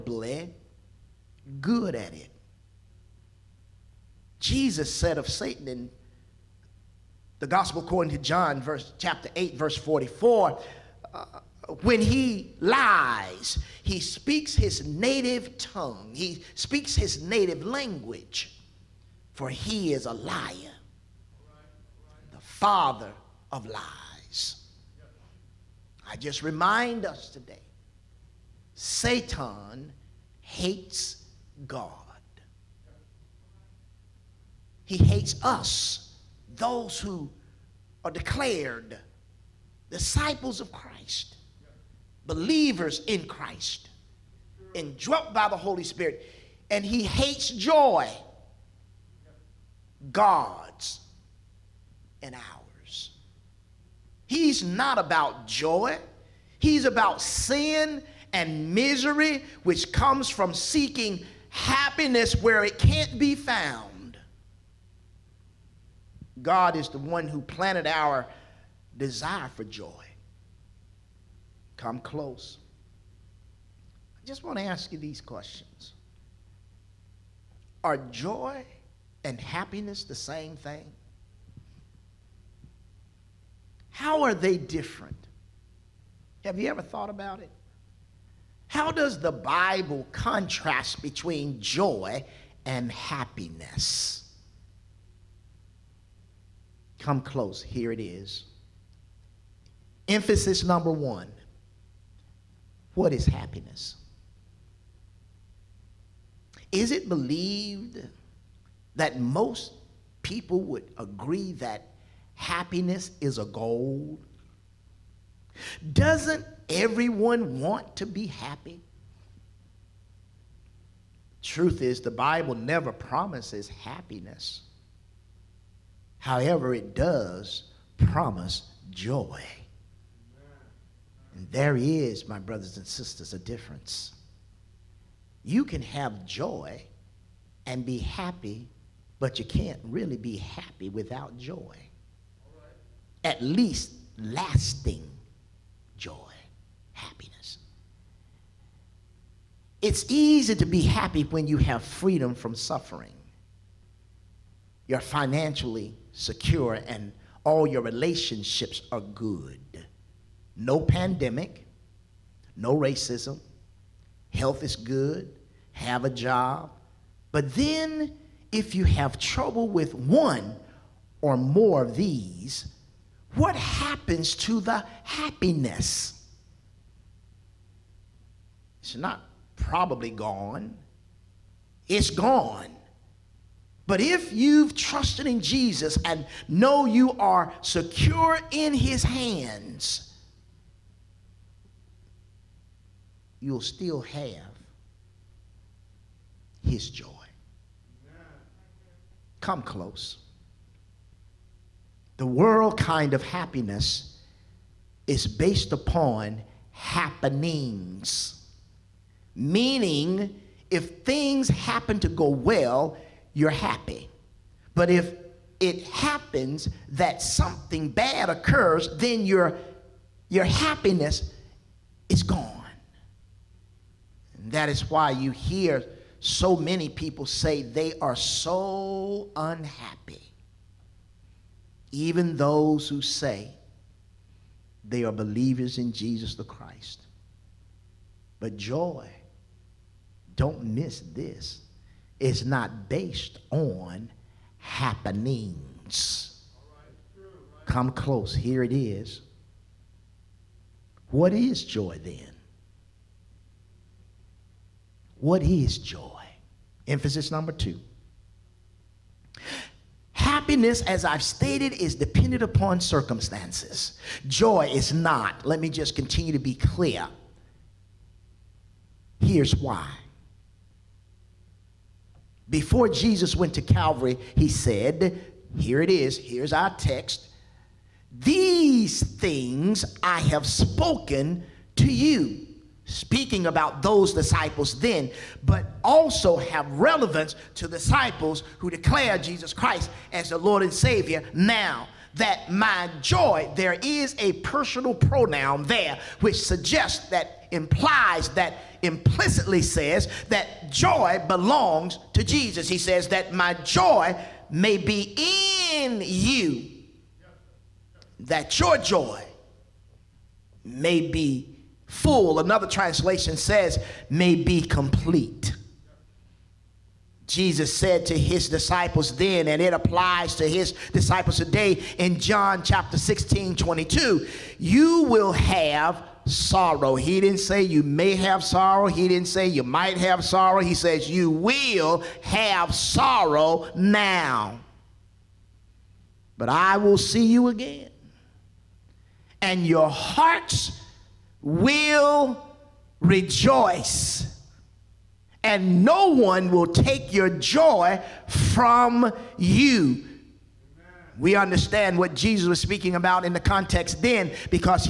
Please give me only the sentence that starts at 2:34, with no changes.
You're financially secure, and all your relationships are good.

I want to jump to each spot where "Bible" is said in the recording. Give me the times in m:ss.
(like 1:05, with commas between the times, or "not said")
1:29, 2:02.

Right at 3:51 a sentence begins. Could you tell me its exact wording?
Even those who say they are believers in Jesus the Christ.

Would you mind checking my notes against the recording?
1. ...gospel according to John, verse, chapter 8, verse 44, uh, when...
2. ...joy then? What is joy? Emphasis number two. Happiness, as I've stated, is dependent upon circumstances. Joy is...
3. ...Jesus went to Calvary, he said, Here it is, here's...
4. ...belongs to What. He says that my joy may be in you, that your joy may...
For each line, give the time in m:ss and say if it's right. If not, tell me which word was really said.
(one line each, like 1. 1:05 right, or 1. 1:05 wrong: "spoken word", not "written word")
1. 0:07 right
2. 4:11 right
3. 4:32 right
4. 5:01 wrong: "Jesus", not "What".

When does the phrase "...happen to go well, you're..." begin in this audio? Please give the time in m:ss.
3:31.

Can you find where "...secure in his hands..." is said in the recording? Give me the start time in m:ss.
3:07.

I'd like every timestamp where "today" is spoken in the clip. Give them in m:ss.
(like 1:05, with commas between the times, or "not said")
0:27, 5:21.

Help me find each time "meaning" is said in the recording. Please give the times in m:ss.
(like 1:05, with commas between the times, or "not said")
3:29.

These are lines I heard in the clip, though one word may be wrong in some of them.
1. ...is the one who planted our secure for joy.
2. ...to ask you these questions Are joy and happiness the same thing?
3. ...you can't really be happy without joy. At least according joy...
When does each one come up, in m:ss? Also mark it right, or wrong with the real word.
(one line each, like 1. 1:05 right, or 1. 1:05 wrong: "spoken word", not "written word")
1. 1:06 wrong: "desire", not "secure"
2. 1:14 right
3. 2:19 wrong: "lasting", not "according".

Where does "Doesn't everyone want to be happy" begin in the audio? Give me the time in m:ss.
1:55.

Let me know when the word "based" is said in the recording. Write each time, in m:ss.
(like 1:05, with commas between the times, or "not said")
3:25, 4:02.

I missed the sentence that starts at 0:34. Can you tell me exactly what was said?
He hates us, those who are declared disciples of Christ, believers in Christ, and indwelt by the Holy Spirit.